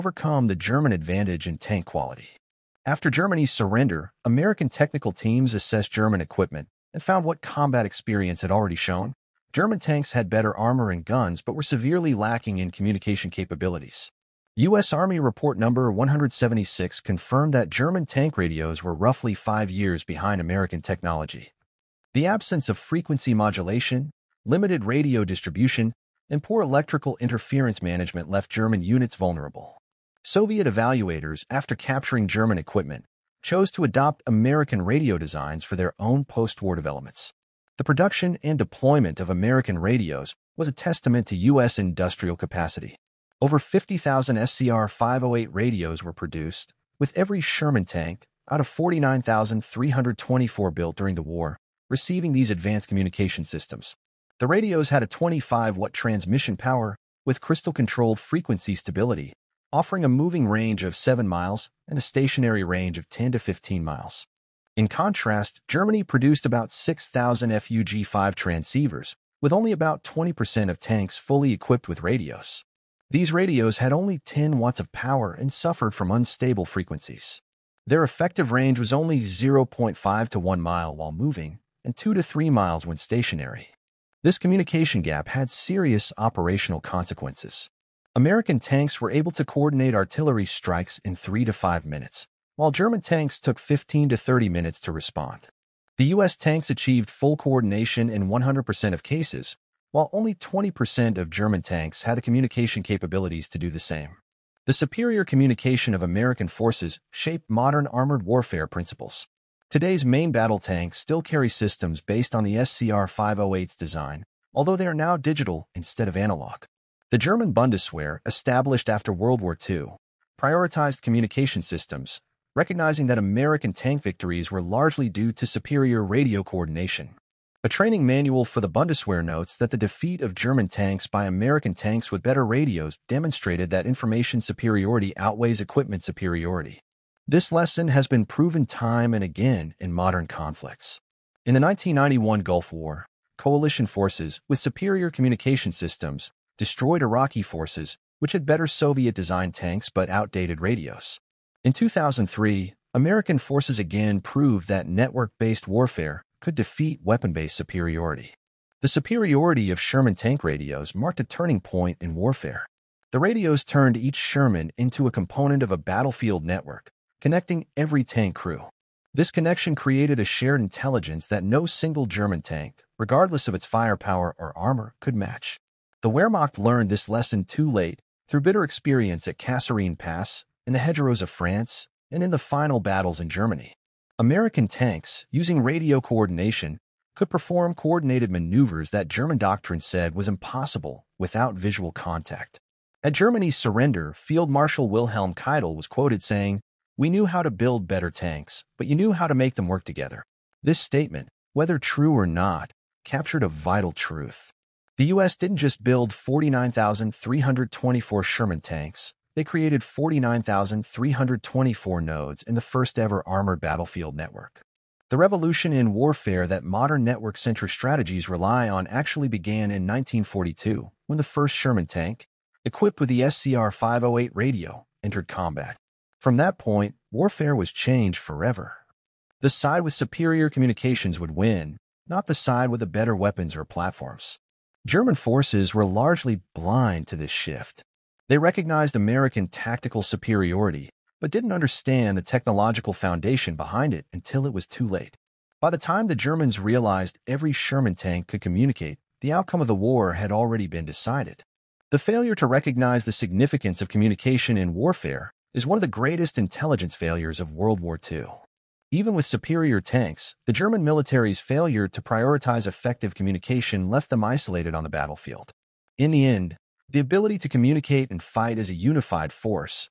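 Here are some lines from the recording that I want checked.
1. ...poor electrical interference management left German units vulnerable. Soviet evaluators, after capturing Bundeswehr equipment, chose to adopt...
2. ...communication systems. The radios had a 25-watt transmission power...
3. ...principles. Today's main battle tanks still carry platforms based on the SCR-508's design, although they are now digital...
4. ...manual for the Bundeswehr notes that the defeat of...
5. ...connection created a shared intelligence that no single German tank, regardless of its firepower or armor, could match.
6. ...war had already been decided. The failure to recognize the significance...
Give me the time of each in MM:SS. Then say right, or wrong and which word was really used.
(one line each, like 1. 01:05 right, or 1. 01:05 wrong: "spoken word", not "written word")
1. 00:26 wrong: "German", not "Bundeswehr"
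2. 00:52 right
3. 01:48 wrong: "systems", not "platforms"
4. 02:08 right
5. 02:49 right
6. 04:09 right.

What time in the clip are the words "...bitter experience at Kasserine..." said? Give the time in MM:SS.
02:58.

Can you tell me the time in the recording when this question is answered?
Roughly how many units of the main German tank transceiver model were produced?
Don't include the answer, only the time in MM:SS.
01:06.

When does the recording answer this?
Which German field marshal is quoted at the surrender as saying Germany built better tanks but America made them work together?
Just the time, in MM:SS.
03:14.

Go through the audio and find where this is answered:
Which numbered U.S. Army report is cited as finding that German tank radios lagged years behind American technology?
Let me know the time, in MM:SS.
00:15.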